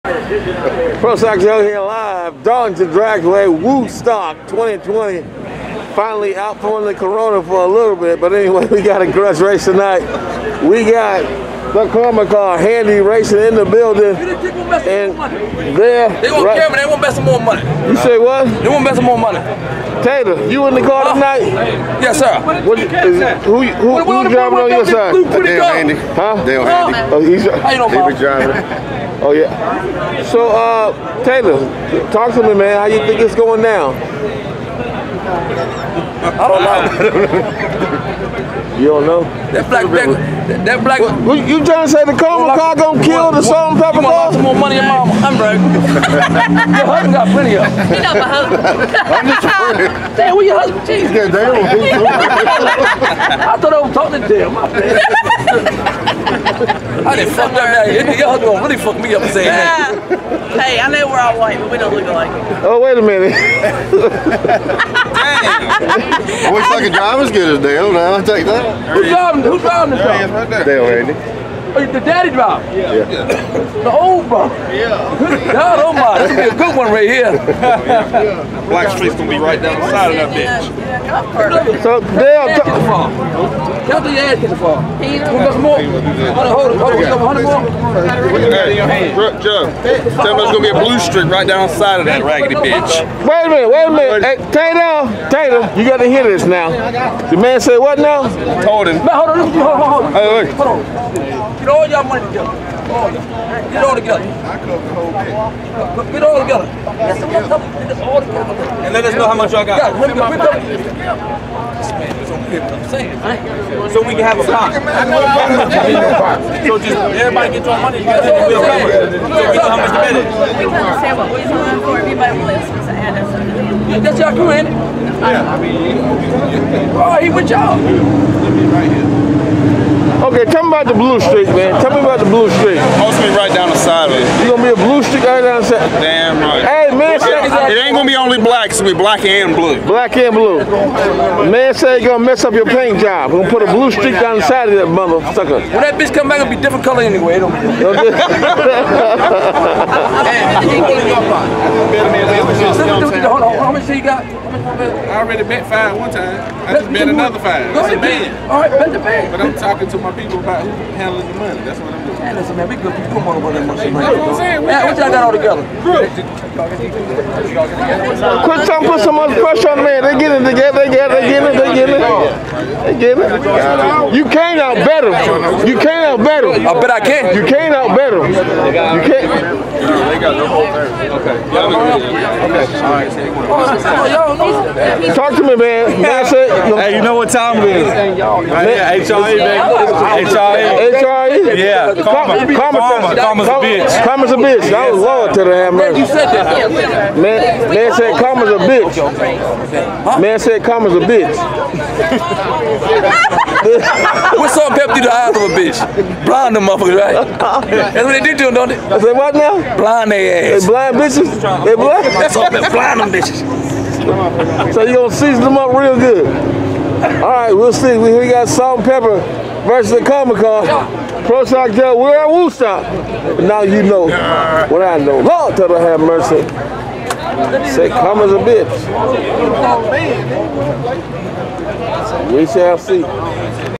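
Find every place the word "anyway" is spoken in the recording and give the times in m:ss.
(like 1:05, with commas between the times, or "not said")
0:08, 2:27.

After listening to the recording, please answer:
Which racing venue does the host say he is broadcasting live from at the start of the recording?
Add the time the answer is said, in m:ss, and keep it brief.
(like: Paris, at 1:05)
Darlington Dragway, at 0:02.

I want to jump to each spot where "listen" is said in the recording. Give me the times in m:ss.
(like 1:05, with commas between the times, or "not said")
2:02, 2:42.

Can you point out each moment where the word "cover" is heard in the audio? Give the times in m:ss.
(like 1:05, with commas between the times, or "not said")
1:58.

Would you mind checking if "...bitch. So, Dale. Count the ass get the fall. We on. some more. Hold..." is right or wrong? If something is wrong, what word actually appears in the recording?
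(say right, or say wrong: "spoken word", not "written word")
right.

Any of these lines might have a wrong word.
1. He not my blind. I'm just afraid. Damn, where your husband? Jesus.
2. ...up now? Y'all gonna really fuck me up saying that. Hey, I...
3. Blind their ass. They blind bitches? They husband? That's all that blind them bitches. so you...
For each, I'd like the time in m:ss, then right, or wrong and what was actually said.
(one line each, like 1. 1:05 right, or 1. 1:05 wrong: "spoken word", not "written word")
1. 0:47 wrong: "husband", not "blind"
2. 0:57 right
3. 3:29 wrong: "blind", not "husband".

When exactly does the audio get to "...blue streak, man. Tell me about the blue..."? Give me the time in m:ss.
2:10.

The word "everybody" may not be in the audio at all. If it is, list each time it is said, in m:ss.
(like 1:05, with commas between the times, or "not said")
1:56, 2:01.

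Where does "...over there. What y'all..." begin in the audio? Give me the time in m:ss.
2:43.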